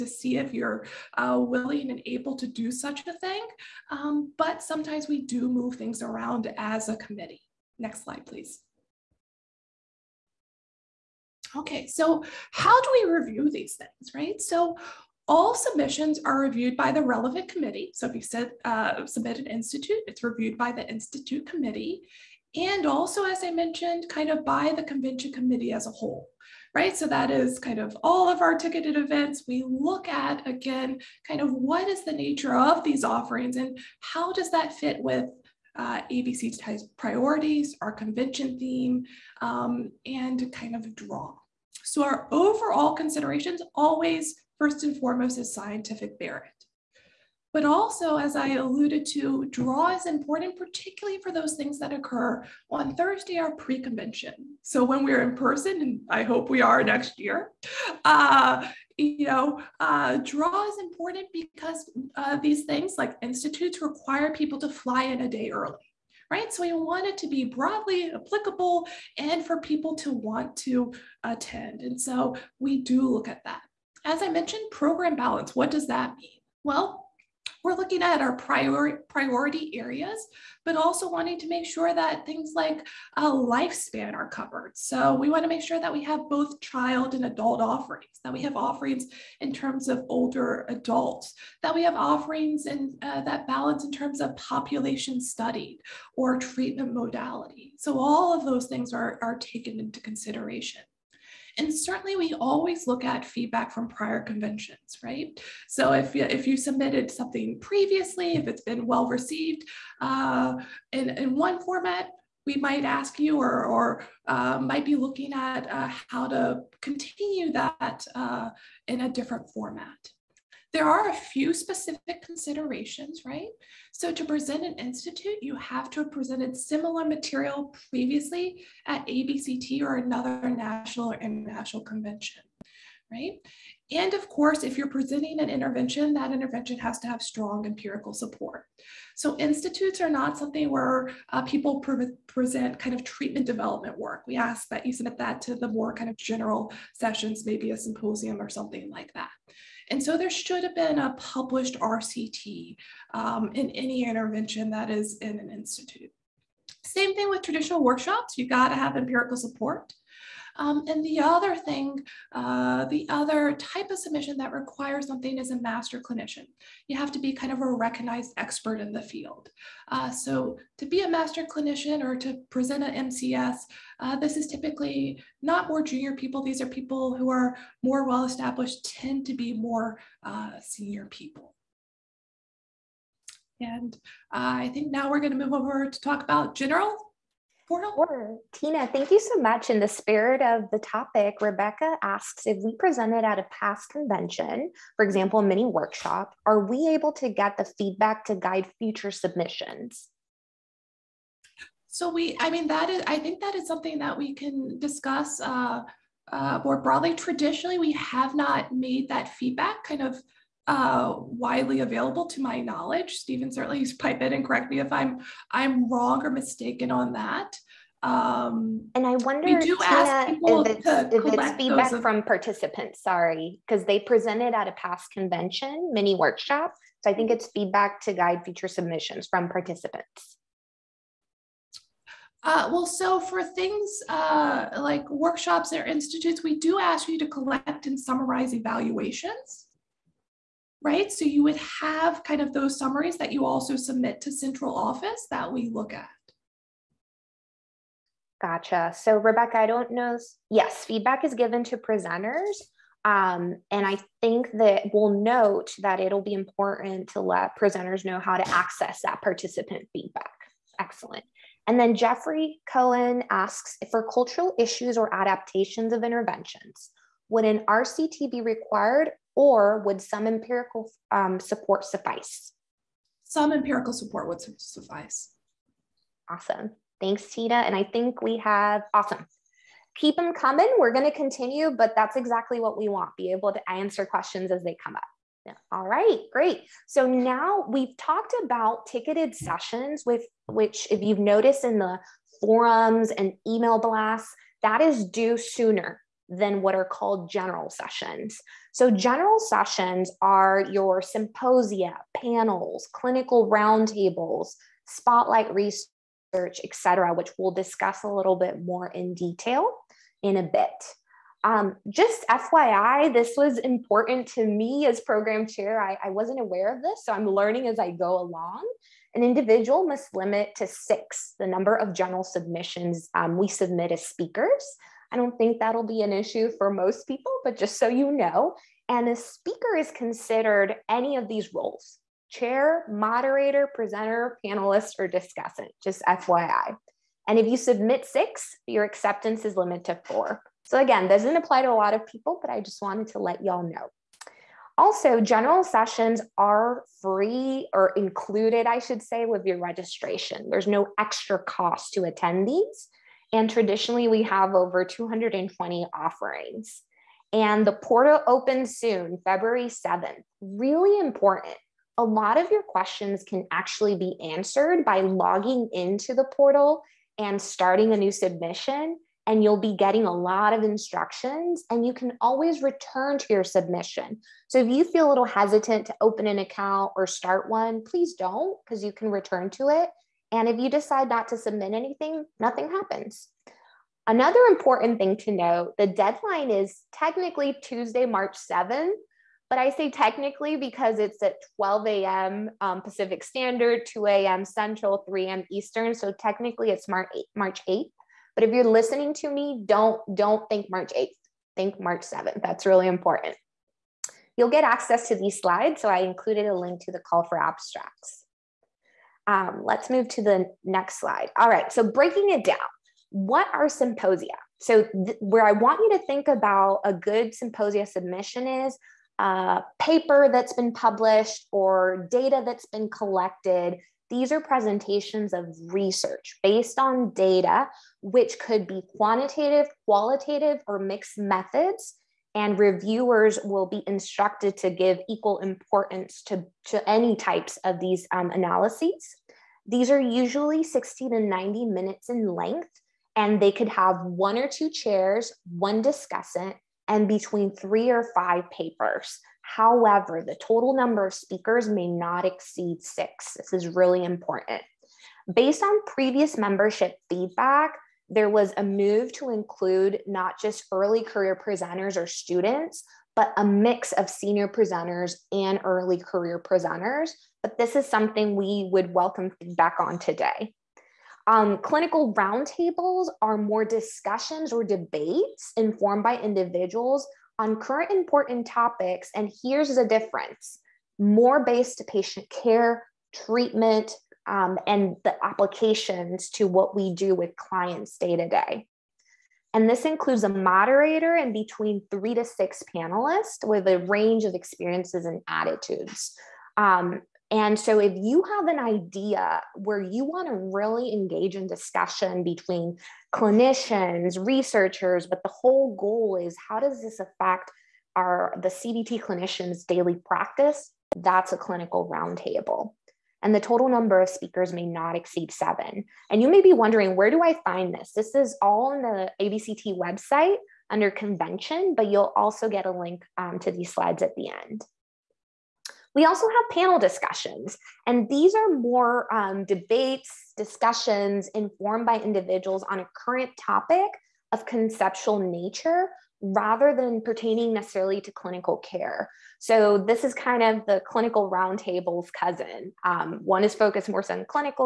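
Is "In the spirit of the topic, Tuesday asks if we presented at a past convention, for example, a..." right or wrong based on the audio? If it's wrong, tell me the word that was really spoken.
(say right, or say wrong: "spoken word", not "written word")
wrong: "Rebecca", not "Tuesday".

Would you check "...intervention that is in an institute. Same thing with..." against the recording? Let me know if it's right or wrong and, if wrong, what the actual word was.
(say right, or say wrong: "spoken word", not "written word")
right.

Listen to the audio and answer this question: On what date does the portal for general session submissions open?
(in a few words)
February 7th.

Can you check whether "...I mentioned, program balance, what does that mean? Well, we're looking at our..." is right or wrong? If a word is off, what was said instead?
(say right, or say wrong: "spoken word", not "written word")
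right.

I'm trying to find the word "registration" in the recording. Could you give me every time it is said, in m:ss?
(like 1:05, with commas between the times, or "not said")
5:49.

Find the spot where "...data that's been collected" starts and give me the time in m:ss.
7:02.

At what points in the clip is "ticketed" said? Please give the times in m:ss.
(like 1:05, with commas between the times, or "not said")
0:28, 4:48.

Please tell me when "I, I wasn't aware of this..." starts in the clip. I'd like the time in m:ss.
5:15.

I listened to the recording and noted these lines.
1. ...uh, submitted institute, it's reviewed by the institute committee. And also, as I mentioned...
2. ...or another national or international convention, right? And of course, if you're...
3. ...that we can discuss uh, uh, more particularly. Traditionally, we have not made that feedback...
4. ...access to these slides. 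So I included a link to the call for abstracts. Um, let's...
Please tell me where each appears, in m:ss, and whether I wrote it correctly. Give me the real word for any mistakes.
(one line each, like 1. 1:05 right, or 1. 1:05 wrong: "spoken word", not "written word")
1. 0:18 right
2. 2:09 right
3. 3:23 wrong: "broadly", not "particularly"
4. 6:44 right.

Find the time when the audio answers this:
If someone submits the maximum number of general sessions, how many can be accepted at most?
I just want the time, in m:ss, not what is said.
5:40.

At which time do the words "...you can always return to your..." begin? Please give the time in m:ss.
6:11.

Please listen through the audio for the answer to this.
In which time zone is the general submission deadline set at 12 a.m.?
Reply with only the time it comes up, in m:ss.
6:32.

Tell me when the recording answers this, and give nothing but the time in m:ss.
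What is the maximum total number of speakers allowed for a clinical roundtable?
8:35.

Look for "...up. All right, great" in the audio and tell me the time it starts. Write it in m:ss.
4:44.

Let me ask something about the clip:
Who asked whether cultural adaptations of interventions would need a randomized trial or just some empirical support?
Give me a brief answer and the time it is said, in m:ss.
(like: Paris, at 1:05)
Jeffrey Cohen, at 4:21.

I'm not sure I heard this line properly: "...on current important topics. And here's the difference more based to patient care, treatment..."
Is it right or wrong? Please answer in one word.
right.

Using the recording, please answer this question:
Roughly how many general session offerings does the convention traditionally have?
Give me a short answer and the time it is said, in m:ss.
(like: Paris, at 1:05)
over 220, at 5:54.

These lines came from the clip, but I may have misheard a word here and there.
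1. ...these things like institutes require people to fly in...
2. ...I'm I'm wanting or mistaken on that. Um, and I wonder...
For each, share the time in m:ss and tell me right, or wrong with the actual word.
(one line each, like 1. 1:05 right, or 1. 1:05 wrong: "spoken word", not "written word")
1. 1:02 right
2. 3:34 wrong: "wrong", not "wanting".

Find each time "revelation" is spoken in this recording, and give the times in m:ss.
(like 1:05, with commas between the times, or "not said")
not said.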